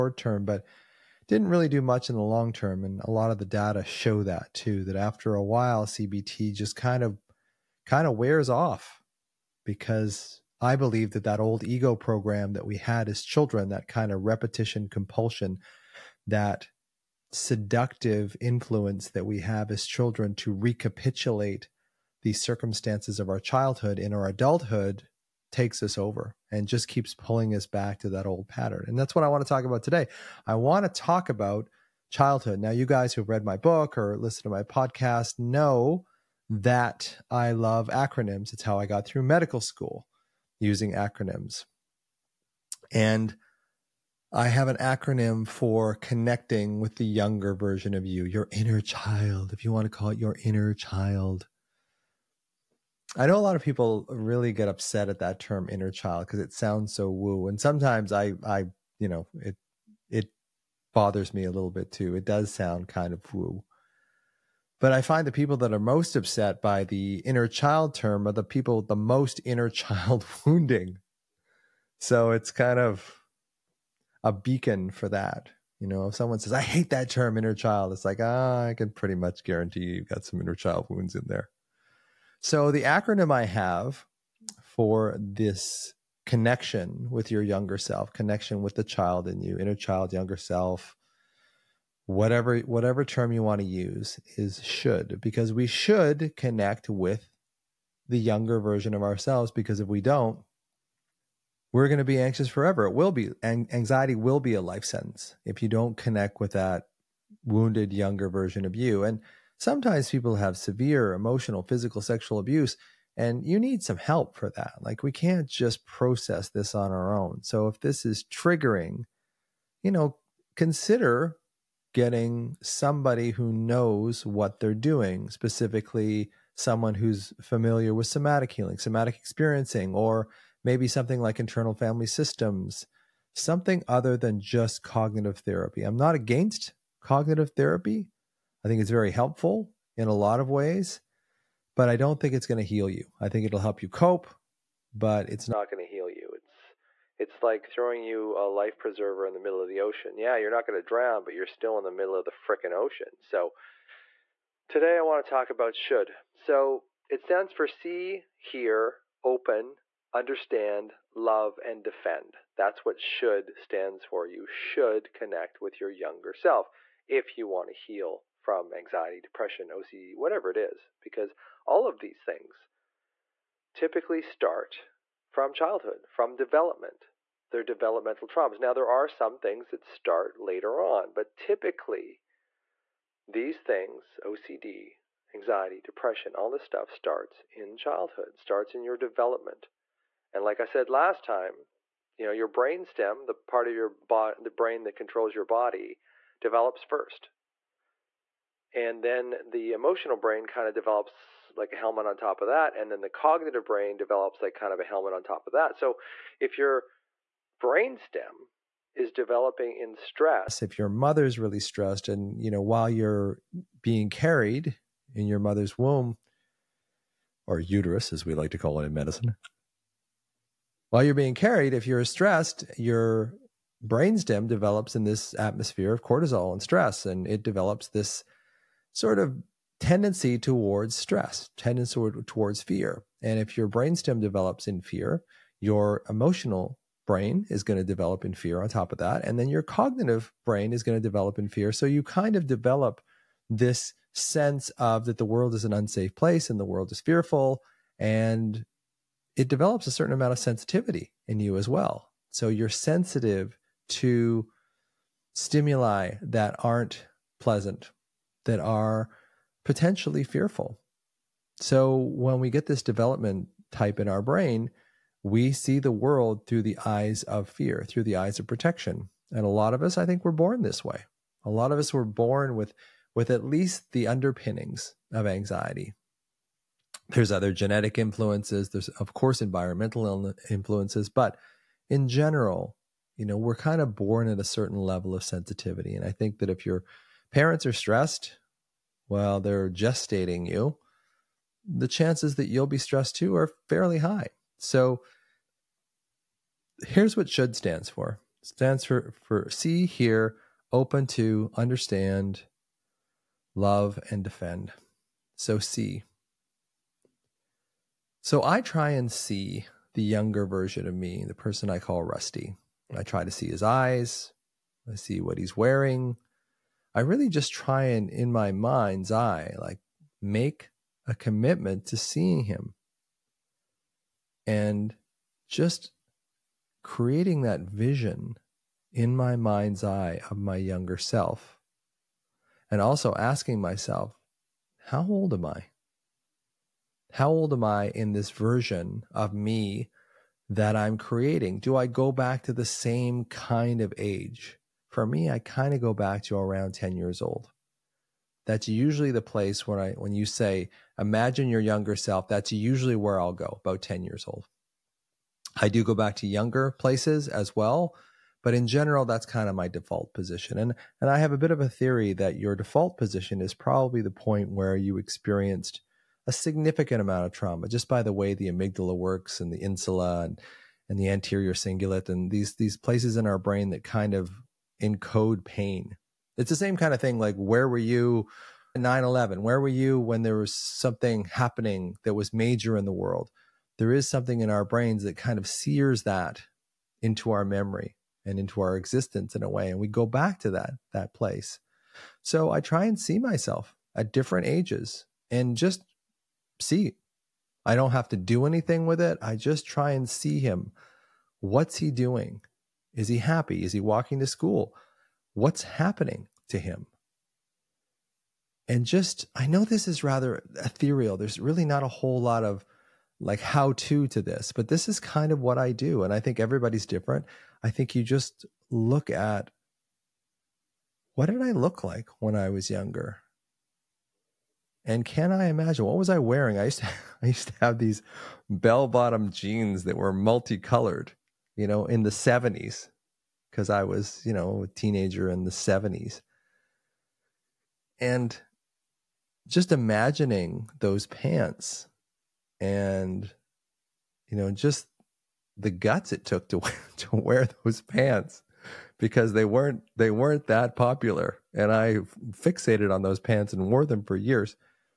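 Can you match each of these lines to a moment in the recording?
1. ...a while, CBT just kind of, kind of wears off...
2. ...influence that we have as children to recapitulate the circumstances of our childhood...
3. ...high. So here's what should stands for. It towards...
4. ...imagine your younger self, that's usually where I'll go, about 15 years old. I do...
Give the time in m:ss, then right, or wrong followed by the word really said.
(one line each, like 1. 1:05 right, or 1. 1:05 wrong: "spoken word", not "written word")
1. 0:05 right
2. 0:18 right
3. 4:53 wrong: "stands", not "towards"
4. 5:50 wrong: "10", not "15".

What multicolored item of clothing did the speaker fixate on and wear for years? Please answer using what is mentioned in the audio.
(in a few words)
Bell bottom jeans.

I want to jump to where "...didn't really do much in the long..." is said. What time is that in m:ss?
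0:01.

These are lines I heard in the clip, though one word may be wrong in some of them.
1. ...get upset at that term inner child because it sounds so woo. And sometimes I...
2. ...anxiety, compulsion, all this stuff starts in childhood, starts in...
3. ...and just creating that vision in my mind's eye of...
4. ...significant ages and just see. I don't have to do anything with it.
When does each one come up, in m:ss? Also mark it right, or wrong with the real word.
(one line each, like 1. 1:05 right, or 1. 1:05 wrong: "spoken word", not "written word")
1. 0:54 right
2. 3:05 wrong: "depression", not "compulsion"
3. 5:24 right
4. 6:34 wrong: "different", not "significant".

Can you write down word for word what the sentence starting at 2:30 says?
Yeah, you're not going to drown, but you're still in the middle of the freaking ocean.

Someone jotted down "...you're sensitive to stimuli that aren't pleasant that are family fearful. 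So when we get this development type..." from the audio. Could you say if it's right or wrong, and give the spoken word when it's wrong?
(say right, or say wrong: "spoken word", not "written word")
wrong: "potentially", not "family".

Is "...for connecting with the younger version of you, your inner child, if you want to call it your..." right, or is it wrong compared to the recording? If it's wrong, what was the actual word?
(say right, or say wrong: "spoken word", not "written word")
right.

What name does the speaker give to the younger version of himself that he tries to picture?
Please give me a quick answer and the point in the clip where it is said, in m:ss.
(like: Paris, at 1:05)
Rusty, at 5:12.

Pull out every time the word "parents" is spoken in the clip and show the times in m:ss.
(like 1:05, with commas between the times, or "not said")
4:47.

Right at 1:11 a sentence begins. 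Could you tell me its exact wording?
So it's kind of a beacon for that.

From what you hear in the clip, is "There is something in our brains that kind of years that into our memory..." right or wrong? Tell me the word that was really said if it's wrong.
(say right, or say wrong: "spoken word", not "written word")
wrong: "sears", not "years".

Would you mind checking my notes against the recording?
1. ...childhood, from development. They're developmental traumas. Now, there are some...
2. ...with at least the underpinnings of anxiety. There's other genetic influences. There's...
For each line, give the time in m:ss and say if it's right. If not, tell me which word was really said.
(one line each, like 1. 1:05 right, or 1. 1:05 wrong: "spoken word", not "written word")
1. 2:55 right
2. 4:33 right.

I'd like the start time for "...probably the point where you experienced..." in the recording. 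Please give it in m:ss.
6:03.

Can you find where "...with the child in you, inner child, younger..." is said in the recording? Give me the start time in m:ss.
1:28.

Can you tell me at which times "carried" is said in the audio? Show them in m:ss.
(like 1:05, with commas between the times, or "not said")
3:34, 3:41.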